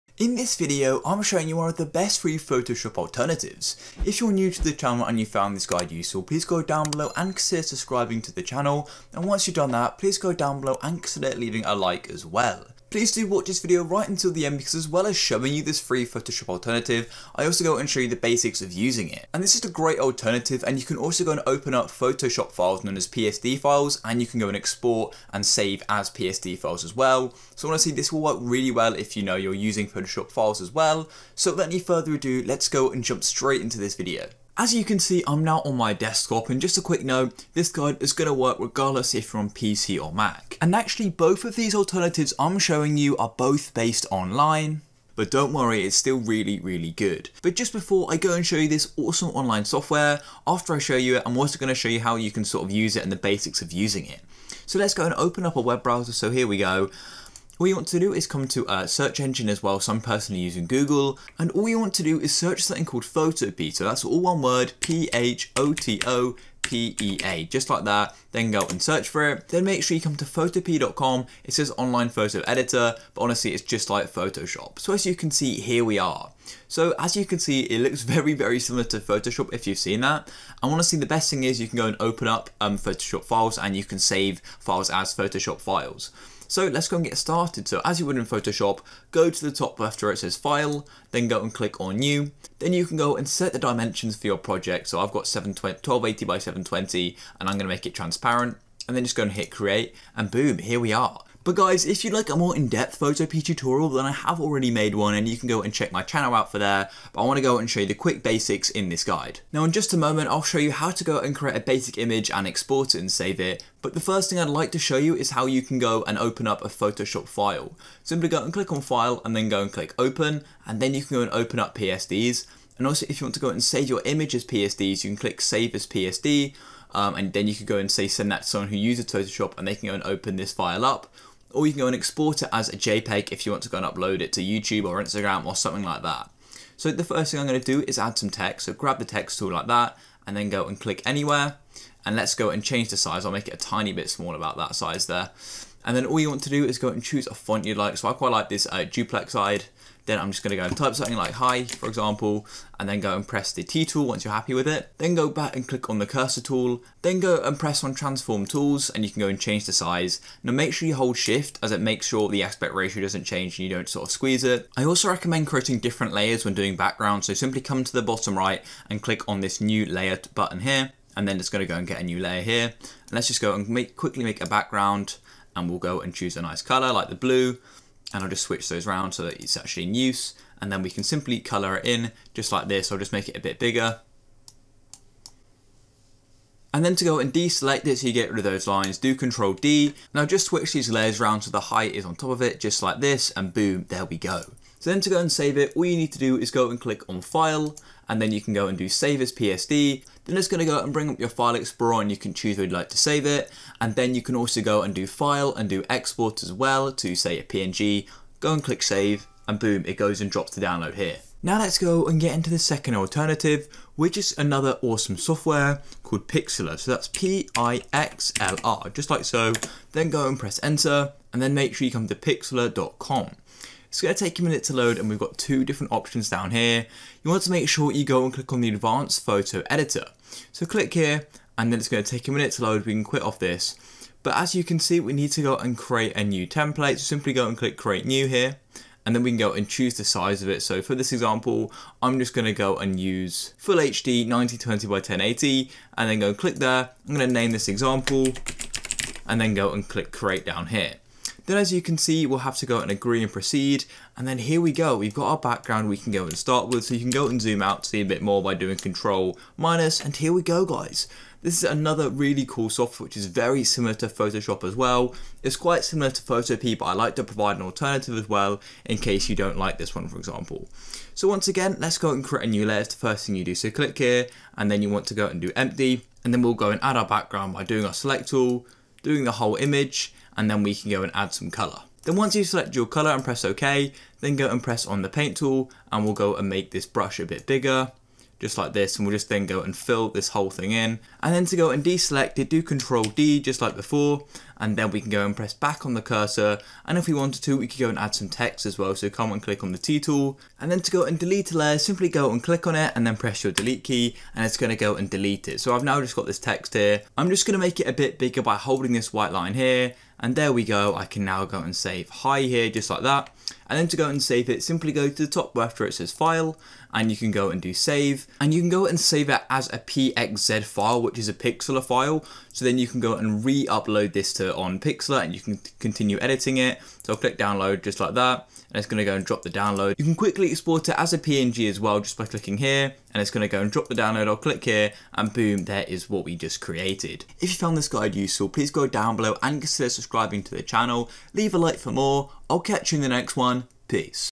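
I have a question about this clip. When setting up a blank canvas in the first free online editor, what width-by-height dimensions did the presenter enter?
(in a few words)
1280 by 720.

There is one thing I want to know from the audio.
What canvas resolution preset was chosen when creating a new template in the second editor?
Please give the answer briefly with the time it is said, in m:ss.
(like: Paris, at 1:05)
1920 by 1080, at 4:04.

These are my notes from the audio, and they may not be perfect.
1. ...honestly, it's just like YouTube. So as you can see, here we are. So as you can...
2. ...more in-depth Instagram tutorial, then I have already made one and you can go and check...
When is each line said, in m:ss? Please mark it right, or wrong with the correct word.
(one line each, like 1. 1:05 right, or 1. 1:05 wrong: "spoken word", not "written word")
1. 1:13 wrong: "Photoshop", not "YouTube"
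2. 1:42 wrong: "Photopea", not "Instagram".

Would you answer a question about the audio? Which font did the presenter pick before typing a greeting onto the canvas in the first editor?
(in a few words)
duplex eyed.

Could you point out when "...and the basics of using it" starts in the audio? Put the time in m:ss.
0:53.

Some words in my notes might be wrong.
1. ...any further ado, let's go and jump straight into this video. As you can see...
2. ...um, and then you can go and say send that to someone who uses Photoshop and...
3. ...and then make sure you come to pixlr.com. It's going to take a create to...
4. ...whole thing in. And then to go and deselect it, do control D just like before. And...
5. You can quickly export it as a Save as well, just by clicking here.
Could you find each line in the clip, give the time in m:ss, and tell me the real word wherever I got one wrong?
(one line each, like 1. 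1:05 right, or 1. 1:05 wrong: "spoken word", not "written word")
1. 0:31 right
2. 2:06 right
3. 3:41 wrong: "minute", not "create"
4. 4:50 right
5. 5:29 wrong: "PNG", not "Save".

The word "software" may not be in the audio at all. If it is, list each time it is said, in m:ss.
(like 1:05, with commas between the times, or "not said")
0:49, 3:35, 4:22.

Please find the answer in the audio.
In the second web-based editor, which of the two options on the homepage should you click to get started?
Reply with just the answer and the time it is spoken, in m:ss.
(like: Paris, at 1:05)
advanced photo editor, at 3:48.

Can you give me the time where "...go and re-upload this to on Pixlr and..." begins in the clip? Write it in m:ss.
5:22.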